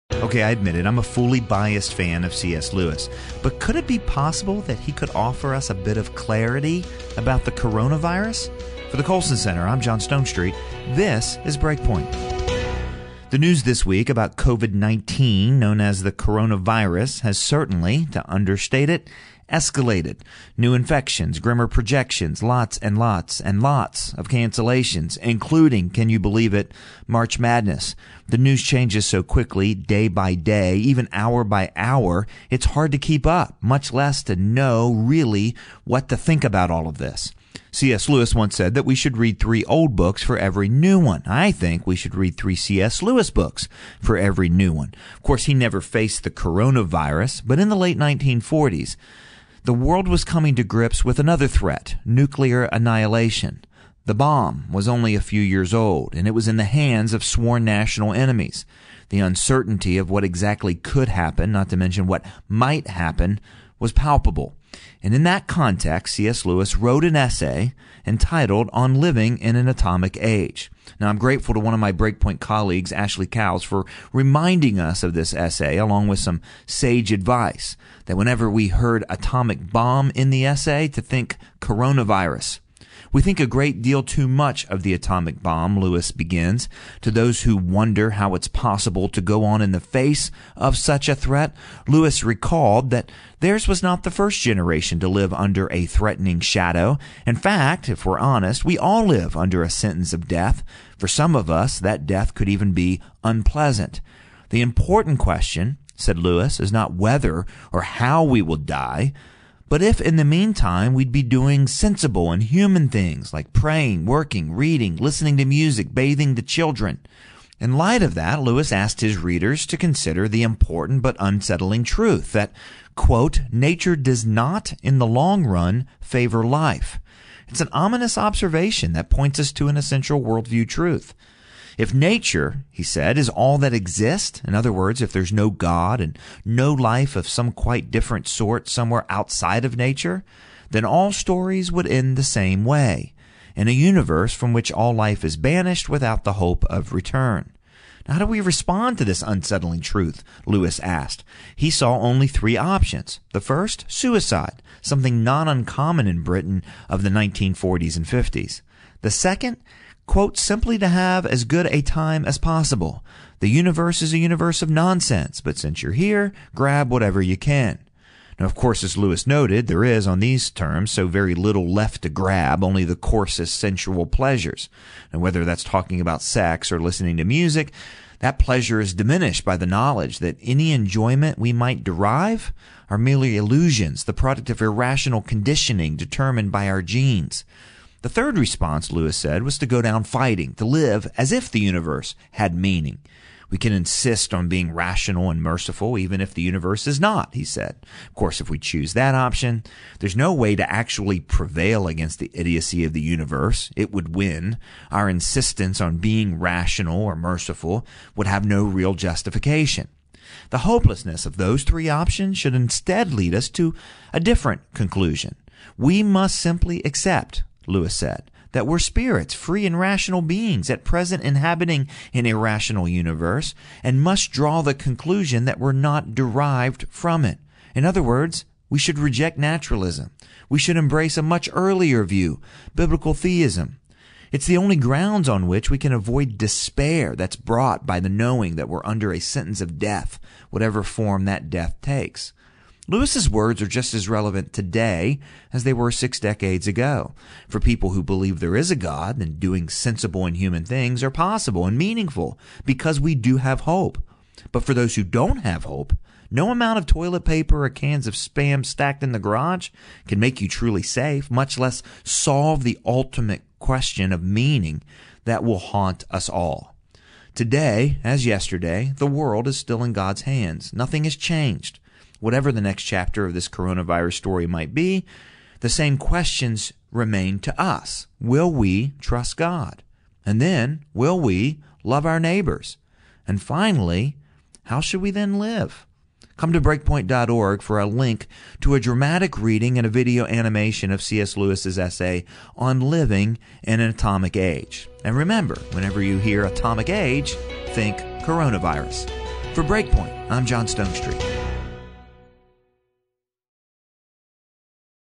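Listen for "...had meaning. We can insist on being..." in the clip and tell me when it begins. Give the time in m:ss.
3:12.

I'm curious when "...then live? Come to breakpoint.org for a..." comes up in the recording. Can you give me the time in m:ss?
4:45.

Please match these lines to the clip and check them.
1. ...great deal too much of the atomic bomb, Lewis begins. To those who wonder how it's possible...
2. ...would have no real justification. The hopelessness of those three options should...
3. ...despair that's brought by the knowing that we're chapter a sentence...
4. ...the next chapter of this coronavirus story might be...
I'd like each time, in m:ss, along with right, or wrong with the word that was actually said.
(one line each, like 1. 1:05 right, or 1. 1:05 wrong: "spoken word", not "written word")
1. 1:23 right
2. 3:28 right
3. 3:56 wrong: "under", not "chapter"
4. 4:32 right.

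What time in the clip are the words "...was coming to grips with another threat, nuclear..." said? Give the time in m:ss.
0:50.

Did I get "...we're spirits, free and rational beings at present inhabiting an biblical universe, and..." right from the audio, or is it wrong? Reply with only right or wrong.
wrong.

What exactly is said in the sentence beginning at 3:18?
Of course, if we choose that option, there's no way to actually prevail against the idiocy of the universe.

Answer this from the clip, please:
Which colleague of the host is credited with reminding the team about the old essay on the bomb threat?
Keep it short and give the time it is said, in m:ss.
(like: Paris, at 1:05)
Ashlee Cowles, at 1:12.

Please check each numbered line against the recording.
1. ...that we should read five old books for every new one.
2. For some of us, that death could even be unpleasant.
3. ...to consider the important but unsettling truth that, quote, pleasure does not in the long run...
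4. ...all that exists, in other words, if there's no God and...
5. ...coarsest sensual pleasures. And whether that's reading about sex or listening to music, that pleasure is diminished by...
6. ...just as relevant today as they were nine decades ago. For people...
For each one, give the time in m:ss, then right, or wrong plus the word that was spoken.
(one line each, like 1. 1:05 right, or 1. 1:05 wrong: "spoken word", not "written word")
1. 0:38 wrong: "three", not "five"
2. 1:40 right
3. 1:59 wrong: "nature", not "pleasure"
4. 2:13 right
5. 2:52 wrong: "talking", not "reading"
6. 4:03 wrong: "six", not "nine".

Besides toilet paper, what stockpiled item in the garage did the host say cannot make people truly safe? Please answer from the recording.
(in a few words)
cans of spam.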